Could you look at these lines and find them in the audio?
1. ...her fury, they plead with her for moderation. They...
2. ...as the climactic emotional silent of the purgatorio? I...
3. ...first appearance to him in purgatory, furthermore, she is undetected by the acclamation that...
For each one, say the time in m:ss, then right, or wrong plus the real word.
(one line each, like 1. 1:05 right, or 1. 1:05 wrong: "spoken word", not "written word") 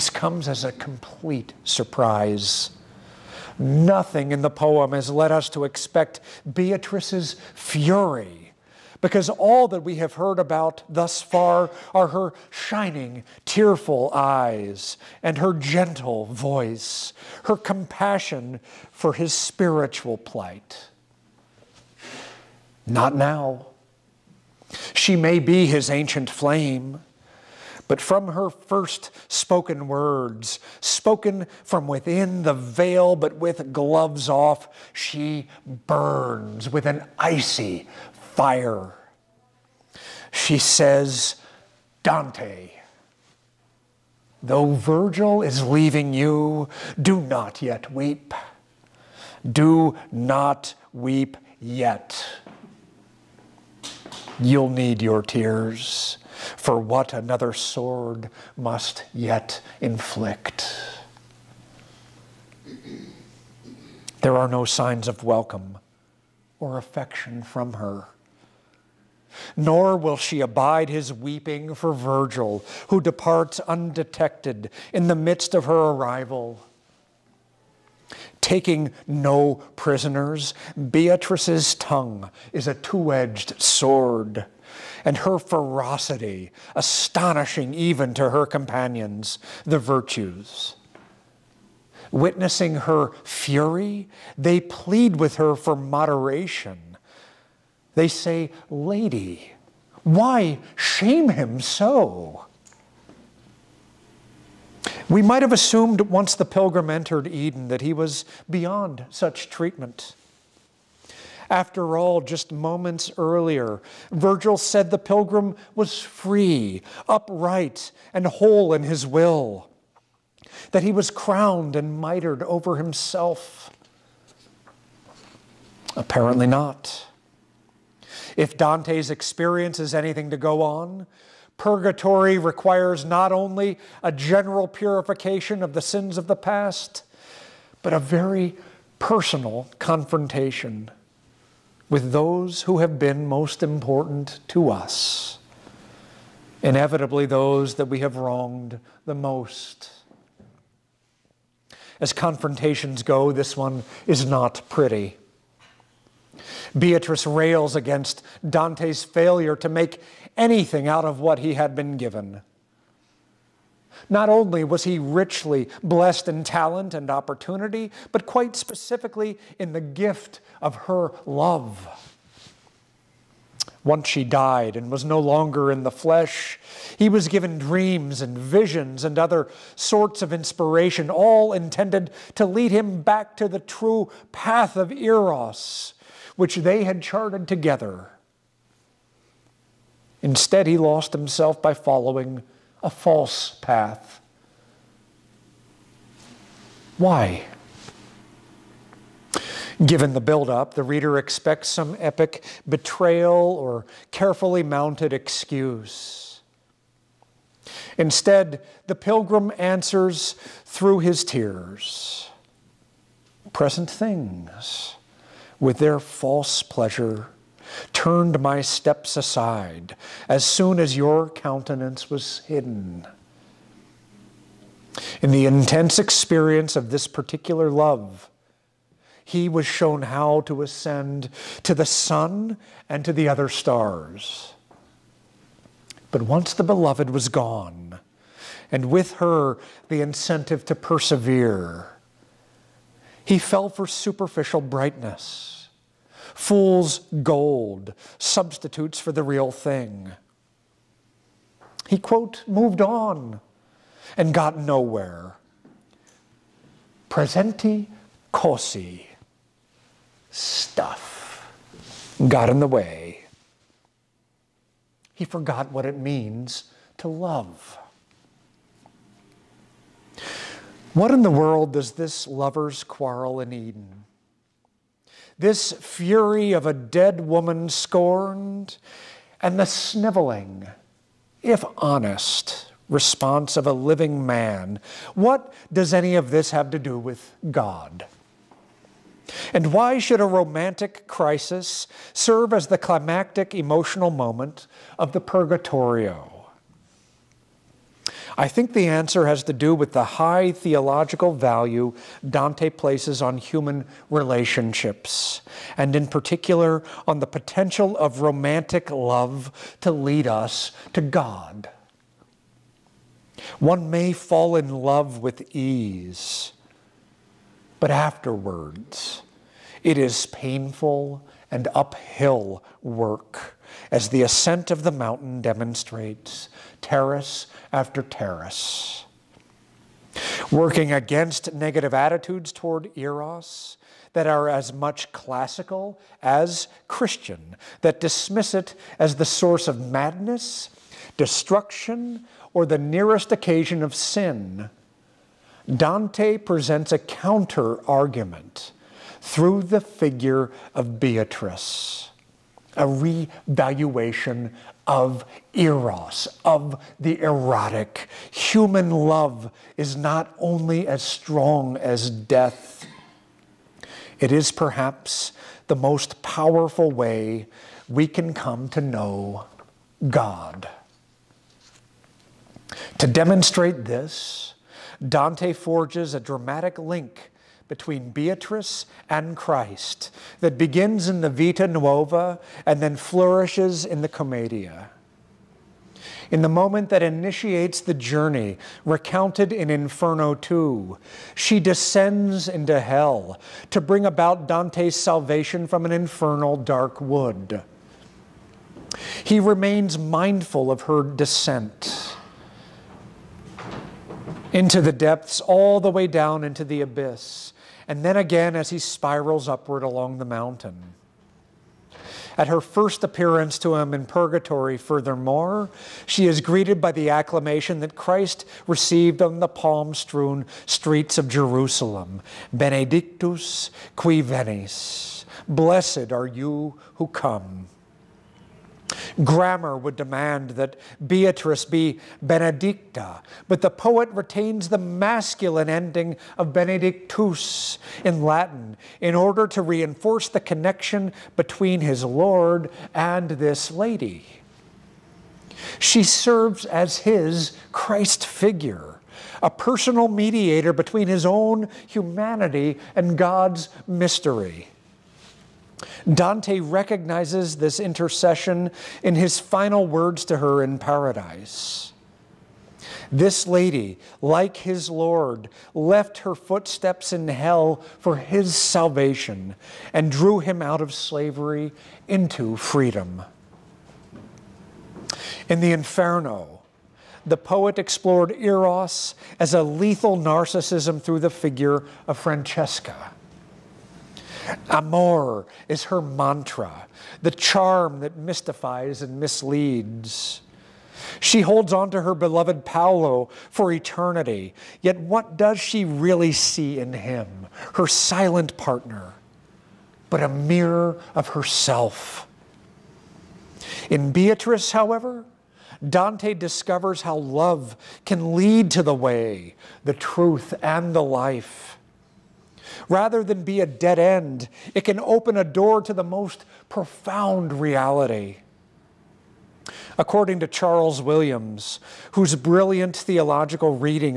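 1. 1:32 right
2. 4:52 wrong: "moment", not "silent"
3. 6:52 wrong: "greeted", not "undetected".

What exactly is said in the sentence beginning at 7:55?
In the Inferno, the poet explored Eros as a lethal narcissism through the figure of Francesca.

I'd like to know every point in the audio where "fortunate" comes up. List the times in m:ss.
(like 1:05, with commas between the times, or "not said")
not said.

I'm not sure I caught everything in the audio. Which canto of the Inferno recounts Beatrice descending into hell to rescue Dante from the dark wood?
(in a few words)
Inferno 2.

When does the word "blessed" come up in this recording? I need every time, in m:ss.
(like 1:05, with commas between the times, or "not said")
2:45, 7:05.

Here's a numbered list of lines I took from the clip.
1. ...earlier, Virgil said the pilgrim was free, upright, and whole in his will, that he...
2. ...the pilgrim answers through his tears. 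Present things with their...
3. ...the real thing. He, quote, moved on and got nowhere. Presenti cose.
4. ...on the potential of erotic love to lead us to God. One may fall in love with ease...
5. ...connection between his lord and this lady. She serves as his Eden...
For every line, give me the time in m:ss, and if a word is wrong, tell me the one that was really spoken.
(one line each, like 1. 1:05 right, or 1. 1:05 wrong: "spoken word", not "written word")
1. 1:53 right
2. 3:28 right
3. 4:09 right
4. 5:07 wrong: "romantic", not "erotic"
5. 7:20 wrong: "Christ", not "Eden".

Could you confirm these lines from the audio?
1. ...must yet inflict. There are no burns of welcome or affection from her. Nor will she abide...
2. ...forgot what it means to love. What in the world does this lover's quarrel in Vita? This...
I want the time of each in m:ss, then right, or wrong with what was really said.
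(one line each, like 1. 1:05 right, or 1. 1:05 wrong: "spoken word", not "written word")
1. 0:58 wrong: "signs", not "burns"
2. 4:25 wrong: "Eden", not "Vita".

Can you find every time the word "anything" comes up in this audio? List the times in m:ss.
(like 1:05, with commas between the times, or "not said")
2:09, 2:40.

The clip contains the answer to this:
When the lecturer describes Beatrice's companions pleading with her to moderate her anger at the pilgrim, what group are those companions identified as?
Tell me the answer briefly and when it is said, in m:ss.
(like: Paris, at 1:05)
the virtues, at 1:29.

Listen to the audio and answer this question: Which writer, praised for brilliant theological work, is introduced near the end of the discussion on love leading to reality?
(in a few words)
Charles Williams.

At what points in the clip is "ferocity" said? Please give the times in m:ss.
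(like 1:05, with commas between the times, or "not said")
1:25.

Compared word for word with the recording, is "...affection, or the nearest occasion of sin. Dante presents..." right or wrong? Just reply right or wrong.
wrong.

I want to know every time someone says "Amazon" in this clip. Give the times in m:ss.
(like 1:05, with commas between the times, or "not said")
not said.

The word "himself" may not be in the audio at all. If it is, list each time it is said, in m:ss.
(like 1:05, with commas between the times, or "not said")
2:02, 3:11.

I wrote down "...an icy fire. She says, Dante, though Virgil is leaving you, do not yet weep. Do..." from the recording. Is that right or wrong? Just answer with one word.
right.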